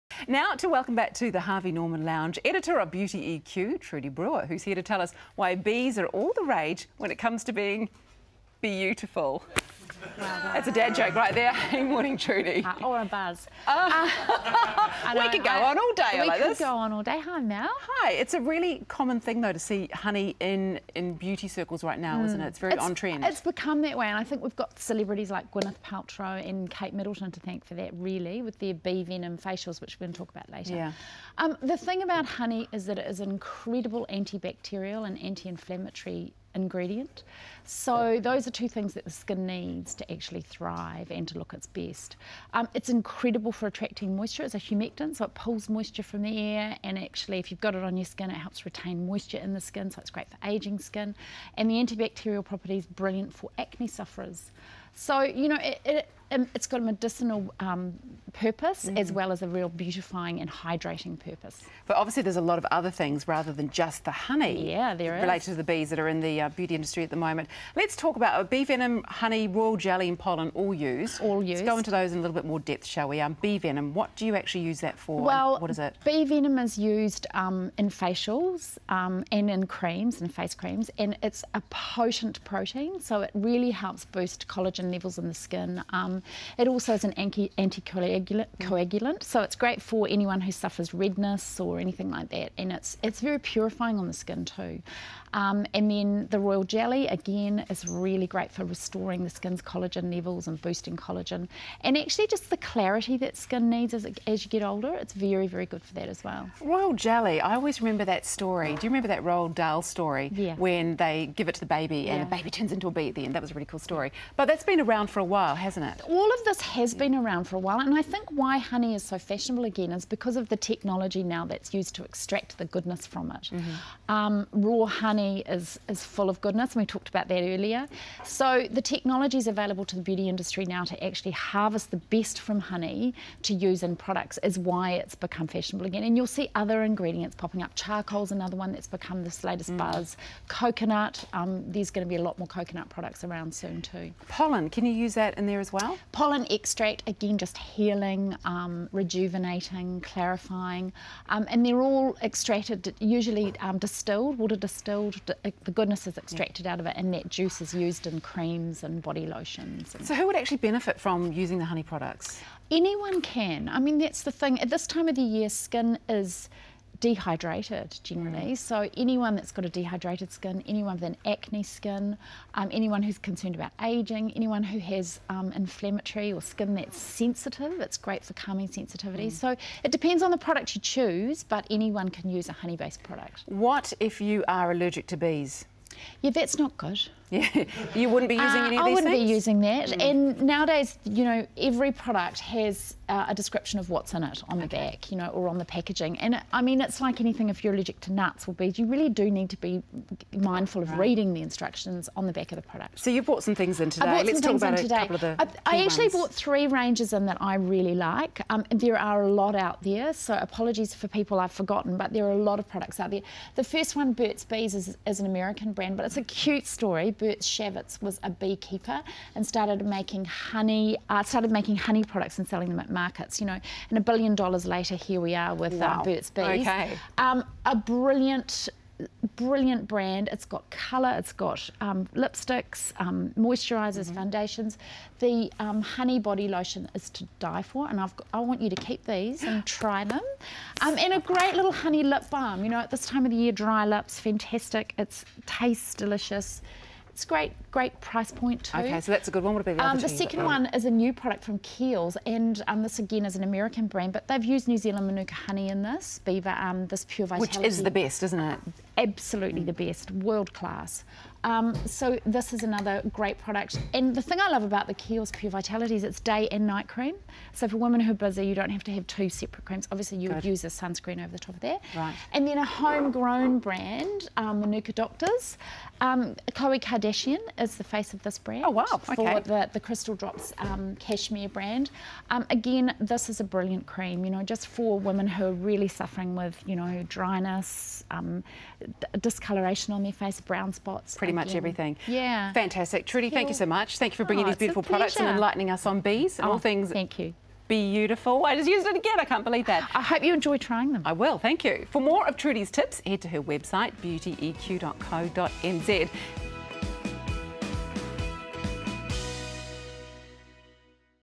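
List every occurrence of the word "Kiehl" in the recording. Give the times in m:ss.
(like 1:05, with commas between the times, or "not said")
4:11, 4:24.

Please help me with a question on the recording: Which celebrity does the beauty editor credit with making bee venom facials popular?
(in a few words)
Gwyneth Paltrow.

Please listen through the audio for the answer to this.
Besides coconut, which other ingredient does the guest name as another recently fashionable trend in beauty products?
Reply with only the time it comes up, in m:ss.
2:17.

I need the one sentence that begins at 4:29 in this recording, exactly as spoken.
Obviously, you would use a sunscreen over the top of there.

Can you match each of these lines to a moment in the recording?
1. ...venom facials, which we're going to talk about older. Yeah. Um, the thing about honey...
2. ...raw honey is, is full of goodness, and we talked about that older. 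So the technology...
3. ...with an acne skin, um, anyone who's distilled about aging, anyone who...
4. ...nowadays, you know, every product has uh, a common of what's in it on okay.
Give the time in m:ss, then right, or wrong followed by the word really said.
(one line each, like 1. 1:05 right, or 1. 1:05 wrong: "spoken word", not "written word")
1. 0:29 wrong: "later", not "older"
2. 2:04 wrong: "earlier", not "older"
3. 2:50 wrong: "concerned", not "distilled"
4. 3:10 wrong: "description", not "common".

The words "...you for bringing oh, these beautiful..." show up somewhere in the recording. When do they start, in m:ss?
4:54.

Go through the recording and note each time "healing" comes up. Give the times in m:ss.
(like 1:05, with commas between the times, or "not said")
2:27.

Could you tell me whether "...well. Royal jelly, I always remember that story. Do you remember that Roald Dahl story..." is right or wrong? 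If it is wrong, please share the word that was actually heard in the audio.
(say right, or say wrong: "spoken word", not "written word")
right.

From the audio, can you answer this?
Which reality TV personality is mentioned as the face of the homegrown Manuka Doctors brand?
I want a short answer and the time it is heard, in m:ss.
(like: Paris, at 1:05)
Khloe Kardashian, at 4:36.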